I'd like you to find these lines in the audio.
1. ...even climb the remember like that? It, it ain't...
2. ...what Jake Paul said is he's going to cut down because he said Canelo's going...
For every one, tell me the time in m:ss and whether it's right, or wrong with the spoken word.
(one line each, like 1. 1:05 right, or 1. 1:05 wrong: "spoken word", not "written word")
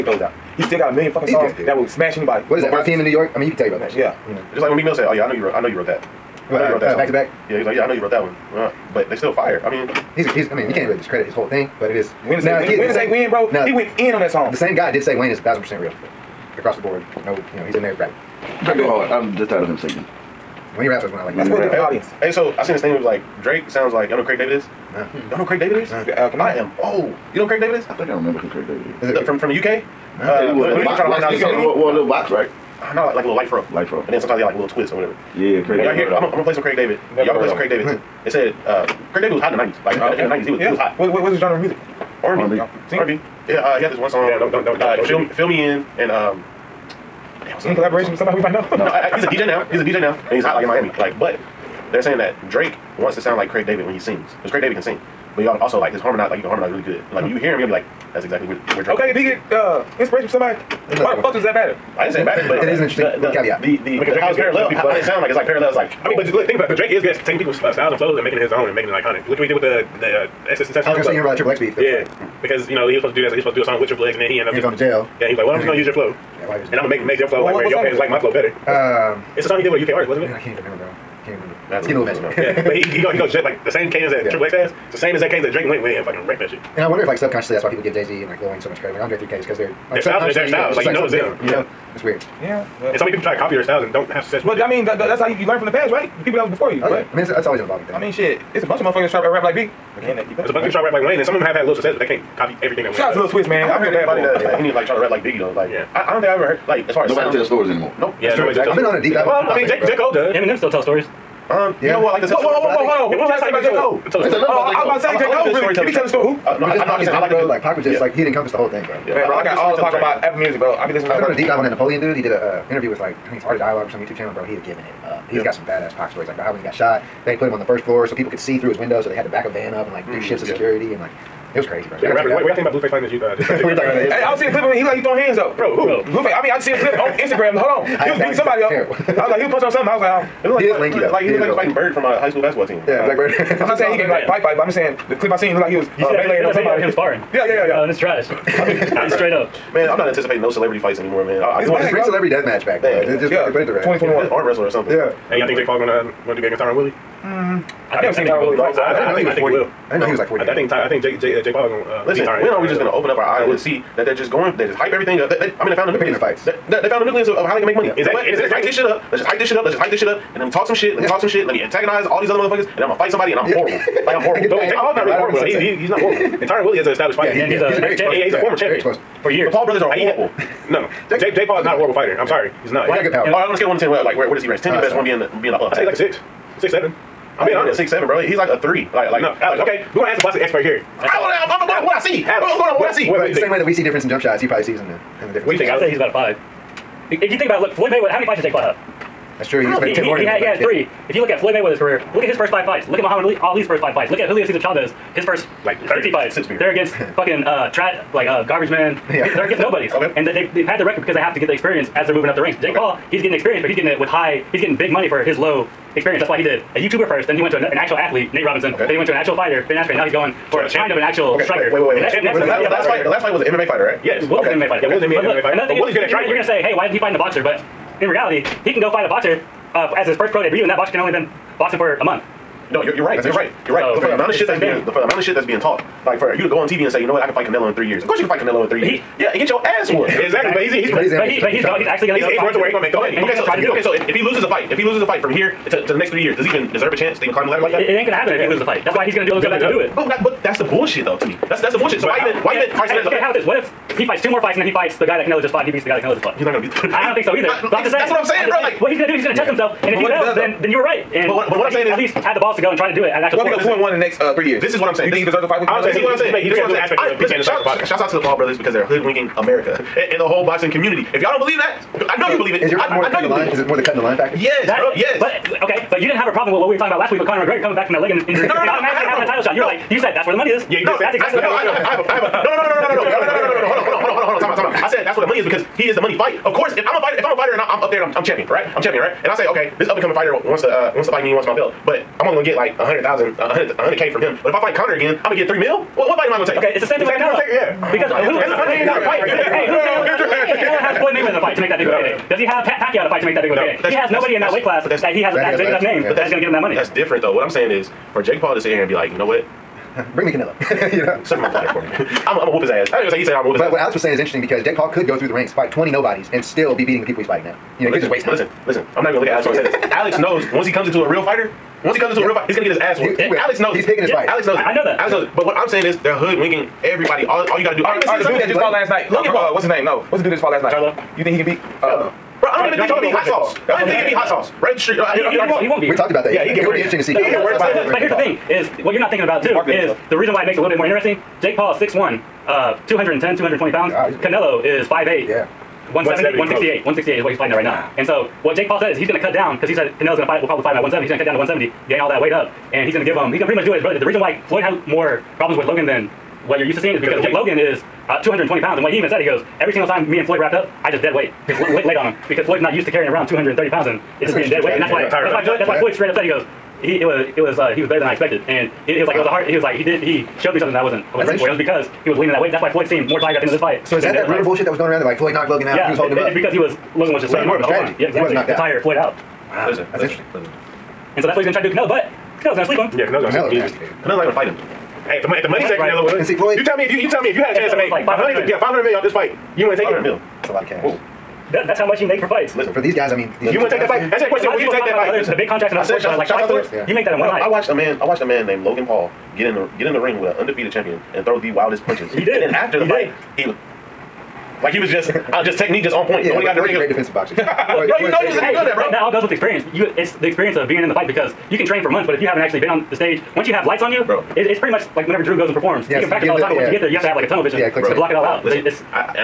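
1. 4:07 wrong: "ladder", not "remember"
2. 5:48 right.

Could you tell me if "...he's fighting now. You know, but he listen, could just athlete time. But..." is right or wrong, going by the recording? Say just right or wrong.
wrong.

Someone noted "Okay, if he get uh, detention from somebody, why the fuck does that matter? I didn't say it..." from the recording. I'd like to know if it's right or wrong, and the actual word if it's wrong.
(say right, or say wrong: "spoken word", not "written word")
wrong: "inspiration", not "detention".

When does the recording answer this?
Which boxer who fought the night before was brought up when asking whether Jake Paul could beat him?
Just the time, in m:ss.
5:30.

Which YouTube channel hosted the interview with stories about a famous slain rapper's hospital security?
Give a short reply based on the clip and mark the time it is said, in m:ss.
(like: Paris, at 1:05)
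Art of Dialogue, at 2:03.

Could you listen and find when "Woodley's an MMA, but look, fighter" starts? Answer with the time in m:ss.
3:44.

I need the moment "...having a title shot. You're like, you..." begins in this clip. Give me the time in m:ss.
4:39.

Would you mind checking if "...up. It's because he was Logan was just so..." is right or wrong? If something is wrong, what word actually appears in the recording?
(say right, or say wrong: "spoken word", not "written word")
right.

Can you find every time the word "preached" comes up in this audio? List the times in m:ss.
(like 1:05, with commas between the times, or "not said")
not said.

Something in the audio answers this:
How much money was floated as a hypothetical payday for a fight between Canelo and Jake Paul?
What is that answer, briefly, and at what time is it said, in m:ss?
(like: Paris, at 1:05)
500 million, at 6:28.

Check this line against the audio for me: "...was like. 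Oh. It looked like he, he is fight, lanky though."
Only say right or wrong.
right.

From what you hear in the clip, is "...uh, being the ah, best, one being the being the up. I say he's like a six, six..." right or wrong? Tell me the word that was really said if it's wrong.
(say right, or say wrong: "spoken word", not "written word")
right.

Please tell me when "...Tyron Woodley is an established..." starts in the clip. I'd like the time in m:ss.
2:56.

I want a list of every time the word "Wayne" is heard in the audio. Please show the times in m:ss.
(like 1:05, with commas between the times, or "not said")
0:15, 1:28, 1:41.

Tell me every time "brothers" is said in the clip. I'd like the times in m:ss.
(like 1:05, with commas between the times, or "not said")
2:59, 4:28, 5:53.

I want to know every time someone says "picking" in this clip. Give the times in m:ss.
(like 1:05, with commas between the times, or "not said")
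2:46, 5:23.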